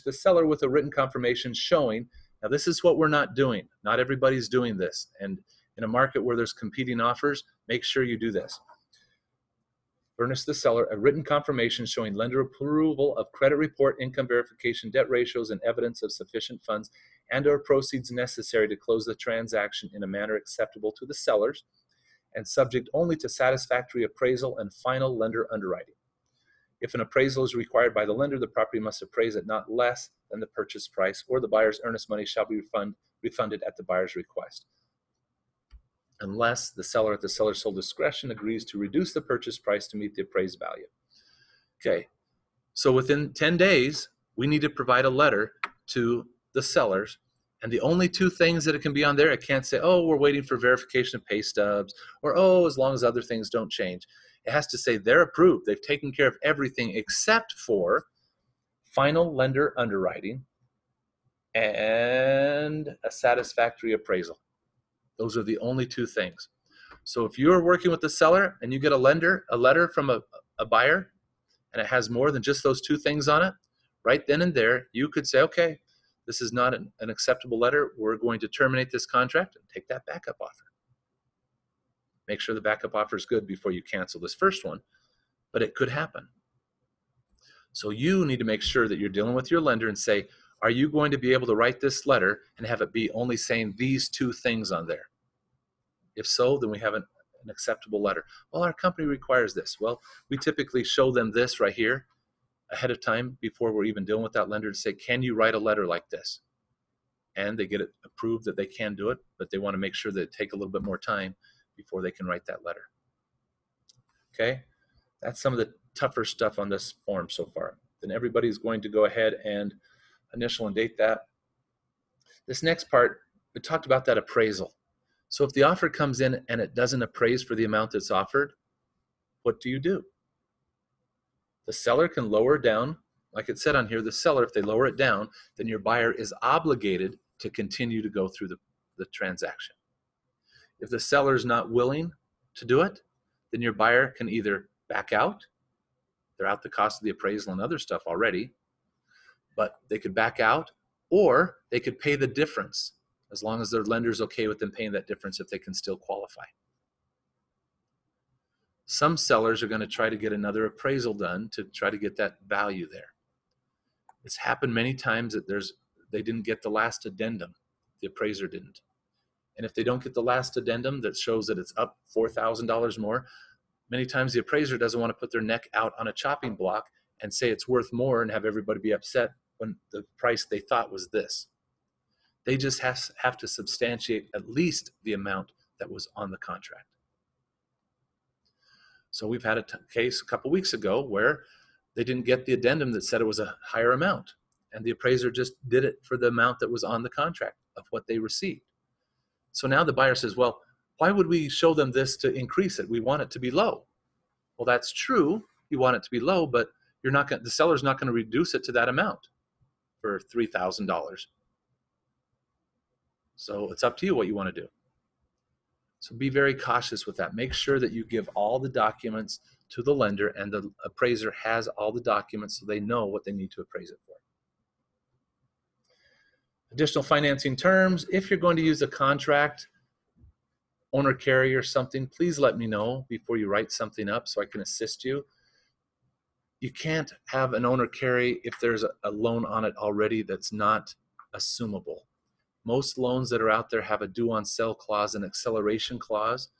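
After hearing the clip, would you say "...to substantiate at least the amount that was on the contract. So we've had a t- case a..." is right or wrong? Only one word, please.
right.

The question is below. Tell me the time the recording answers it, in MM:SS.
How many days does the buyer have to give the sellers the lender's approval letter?
00:42.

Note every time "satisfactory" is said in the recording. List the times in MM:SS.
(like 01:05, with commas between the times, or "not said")
00:23, 01:03.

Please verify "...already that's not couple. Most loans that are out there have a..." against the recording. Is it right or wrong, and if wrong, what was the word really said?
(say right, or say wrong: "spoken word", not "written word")
wrong: "assumable", not "couple".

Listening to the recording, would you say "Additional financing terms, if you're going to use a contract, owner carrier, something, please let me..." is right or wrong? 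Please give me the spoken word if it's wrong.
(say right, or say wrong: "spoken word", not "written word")
right.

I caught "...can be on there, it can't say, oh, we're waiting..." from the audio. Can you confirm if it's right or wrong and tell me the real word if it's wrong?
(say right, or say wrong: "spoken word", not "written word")
right.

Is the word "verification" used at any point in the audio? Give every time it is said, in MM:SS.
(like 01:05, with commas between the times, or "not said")
00:14, 00:50.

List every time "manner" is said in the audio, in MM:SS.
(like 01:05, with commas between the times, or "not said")
00:20.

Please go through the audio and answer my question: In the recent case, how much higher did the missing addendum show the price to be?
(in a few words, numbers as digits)
$4,000.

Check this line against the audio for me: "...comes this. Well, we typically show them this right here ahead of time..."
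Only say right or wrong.
wrong.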